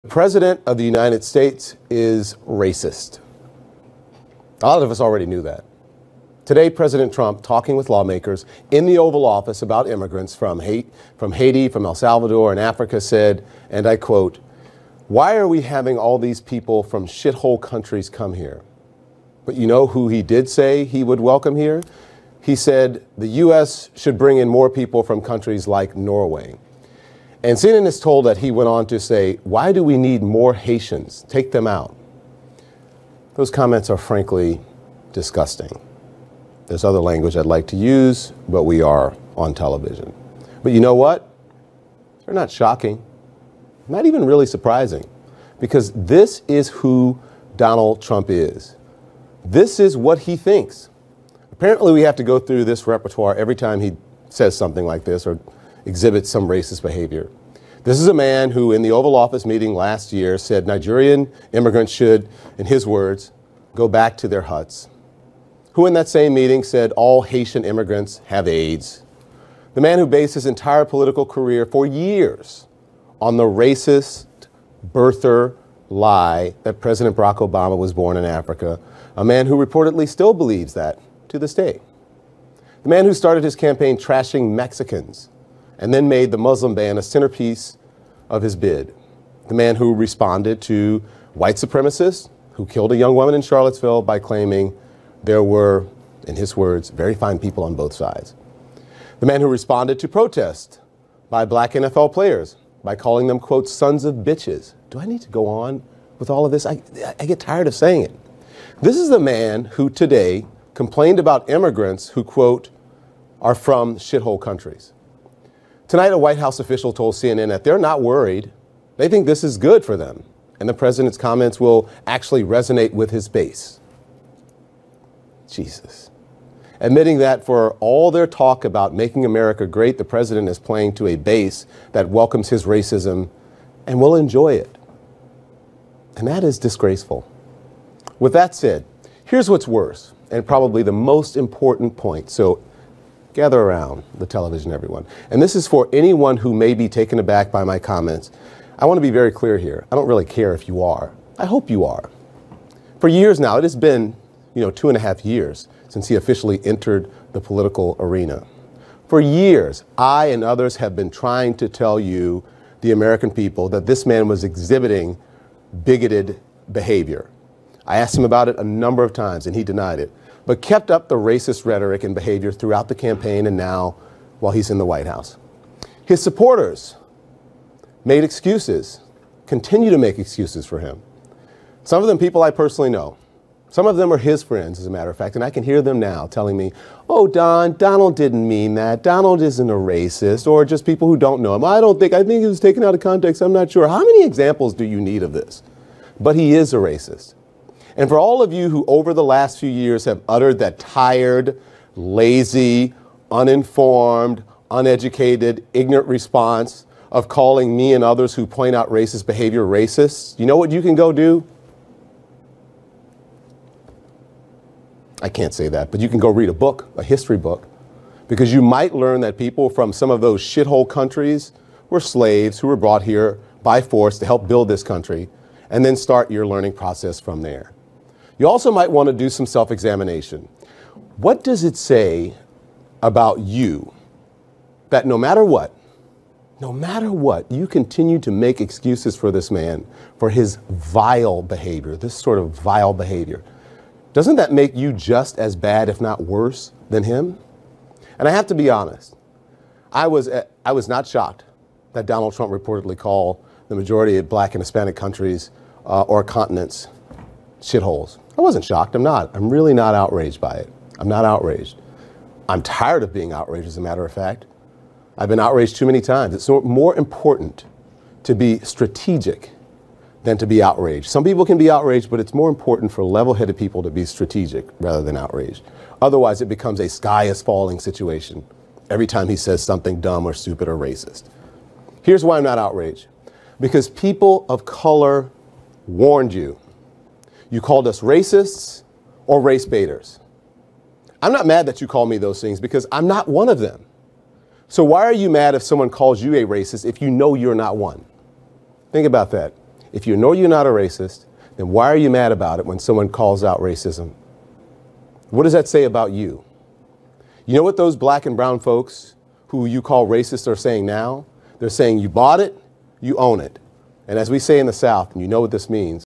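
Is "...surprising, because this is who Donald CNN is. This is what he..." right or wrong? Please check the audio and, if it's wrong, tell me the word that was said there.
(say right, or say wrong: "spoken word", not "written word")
wrong: "Trump", not "CNN".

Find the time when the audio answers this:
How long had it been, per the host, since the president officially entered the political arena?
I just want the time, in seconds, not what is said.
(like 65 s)
154 s.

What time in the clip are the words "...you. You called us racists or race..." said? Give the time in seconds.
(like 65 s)
286 s.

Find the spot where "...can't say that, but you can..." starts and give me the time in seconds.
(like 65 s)
215 s.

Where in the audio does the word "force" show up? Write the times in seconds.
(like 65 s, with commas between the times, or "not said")
223 s.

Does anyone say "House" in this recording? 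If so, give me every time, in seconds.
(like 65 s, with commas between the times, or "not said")
116 s, 175 s.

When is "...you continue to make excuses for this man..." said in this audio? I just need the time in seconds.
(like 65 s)
237 s.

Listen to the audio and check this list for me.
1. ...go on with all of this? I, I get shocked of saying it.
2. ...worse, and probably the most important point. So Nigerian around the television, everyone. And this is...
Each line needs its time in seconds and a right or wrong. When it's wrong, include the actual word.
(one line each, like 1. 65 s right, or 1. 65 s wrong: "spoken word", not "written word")
1. 105 s wrong: "tired", not "shocked"
2. 139 s wrong: "Gather", not "Nigerian".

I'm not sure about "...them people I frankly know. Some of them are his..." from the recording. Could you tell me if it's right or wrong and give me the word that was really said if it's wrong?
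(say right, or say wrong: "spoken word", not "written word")
wrong: "personally", not "frankly".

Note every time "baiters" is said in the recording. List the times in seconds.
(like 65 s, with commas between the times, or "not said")
289 s.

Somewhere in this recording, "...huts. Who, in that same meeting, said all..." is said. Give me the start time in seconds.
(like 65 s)
64 s.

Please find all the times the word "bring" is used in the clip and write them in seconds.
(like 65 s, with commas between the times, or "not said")
24 s.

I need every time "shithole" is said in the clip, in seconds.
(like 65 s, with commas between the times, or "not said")
17 s, 113 s, 220 s, 257 s.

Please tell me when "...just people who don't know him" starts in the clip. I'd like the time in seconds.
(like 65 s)
190 s.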